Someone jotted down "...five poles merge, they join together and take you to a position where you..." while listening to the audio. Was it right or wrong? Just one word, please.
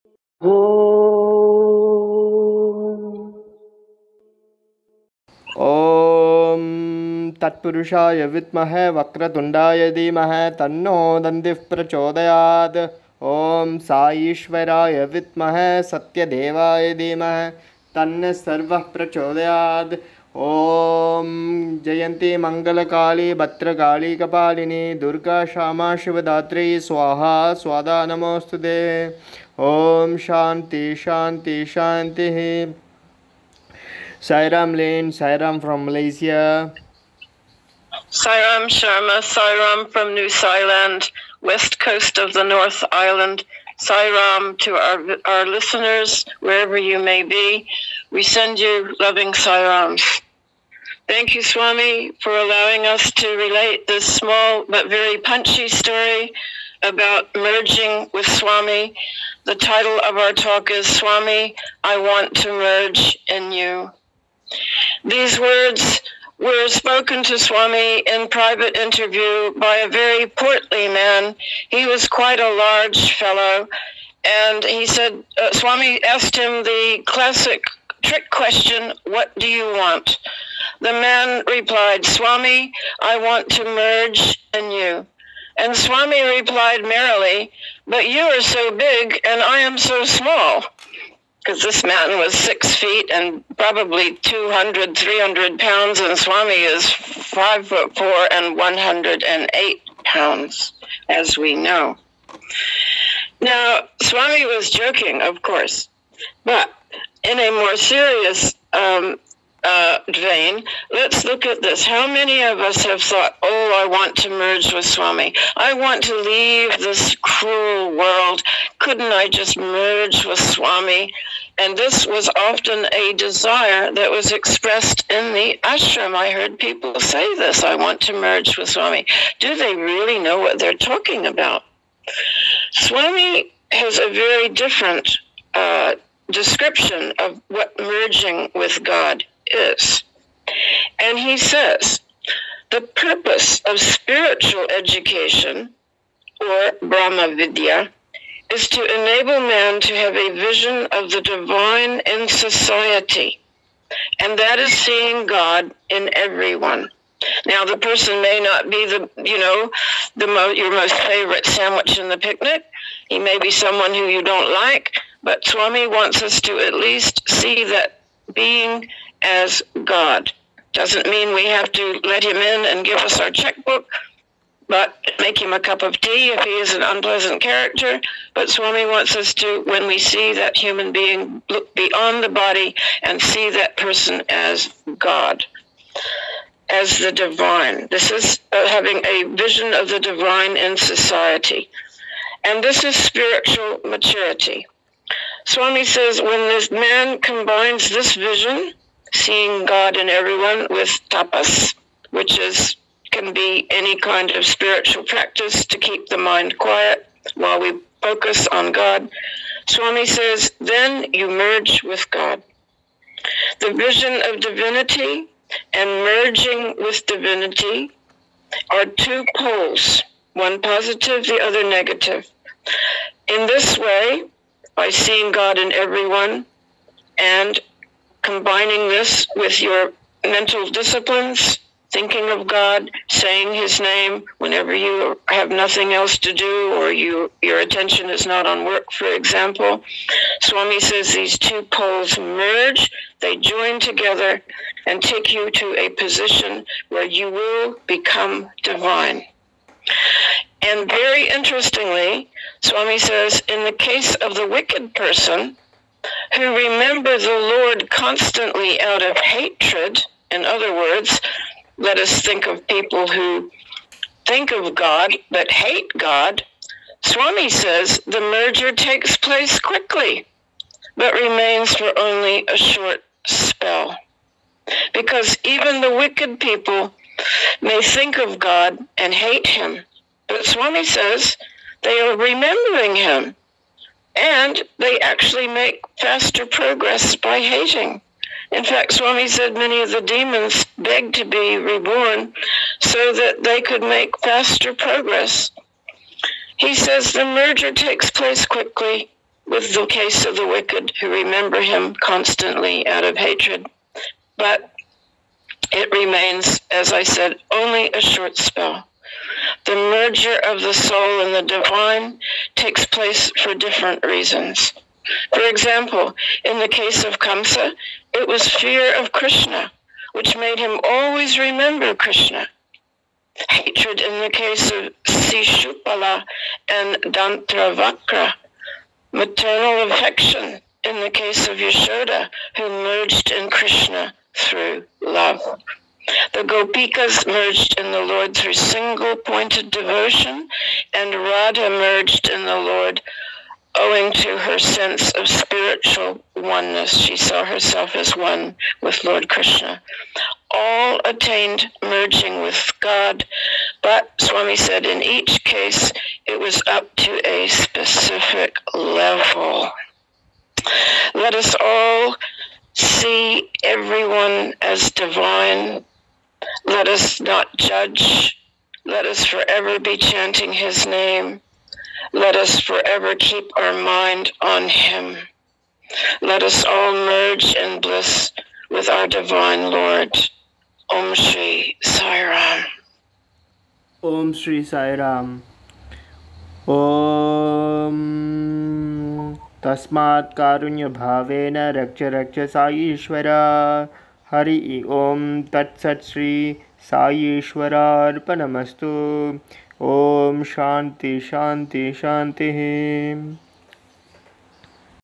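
wrong.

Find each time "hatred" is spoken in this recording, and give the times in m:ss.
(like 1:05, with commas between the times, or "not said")
4:19, 5:03, 5:23.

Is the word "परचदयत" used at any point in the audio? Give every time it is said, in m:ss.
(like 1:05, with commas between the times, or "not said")
0:11, 0:18.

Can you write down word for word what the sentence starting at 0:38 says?
Sairam Sharma, Sairam from New Zealand, west coast of the North Island.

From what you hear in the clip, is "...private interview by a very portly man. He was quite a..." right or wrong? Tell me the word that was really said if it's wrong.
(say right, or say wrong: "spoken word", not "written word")
right.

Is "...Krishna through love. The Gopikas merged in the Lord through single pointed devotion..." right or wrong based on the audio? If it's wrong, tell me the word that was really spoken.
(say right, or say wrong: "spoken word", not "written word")
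right.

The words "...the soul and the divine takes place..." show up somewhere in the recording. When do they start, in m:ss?
5:10.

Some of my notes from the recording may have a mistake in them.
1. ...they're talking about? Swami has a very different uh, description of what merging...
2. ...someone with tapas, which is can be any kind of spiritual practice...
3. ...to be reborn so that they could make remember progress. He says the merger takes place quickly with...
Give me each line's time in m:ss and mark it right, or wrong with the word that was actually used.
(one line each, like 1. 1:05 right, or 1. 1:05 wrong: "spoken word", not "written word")
1. 2:10 right
2. 3:20 wrong: "everyone", not "someone"
3. 4:51 wrong: "faster", not "remember".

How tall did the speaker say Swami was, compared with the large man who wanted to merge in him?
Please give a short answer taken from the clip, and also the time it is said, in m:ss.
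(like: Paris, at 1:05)
5 foot 4, at 1:36.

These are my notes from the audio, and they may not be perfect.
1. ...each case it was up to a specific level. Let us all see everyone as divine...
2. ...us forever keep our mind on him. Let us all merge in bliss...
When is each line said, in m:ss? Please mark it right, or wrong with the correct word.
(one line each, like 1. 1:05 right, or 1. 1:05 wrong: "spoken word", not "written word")
1. 5:55 right
2. 6:12 right.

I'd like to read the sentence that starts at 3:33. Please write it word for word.
The vision of divinity and merging with divinity are two poles, one positive, the other negative.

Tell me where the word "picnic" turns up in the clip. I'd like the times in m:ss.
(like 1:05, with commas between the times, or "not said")
2:42.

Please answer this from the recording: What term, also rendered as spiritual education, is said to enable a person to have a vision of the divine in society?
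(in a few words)
Brahma Vidya.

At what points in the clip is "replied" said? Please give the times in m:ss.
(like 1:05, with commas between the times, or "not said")
1:21, 1:26.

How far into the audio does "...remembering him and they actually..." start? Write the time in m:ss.
4:42.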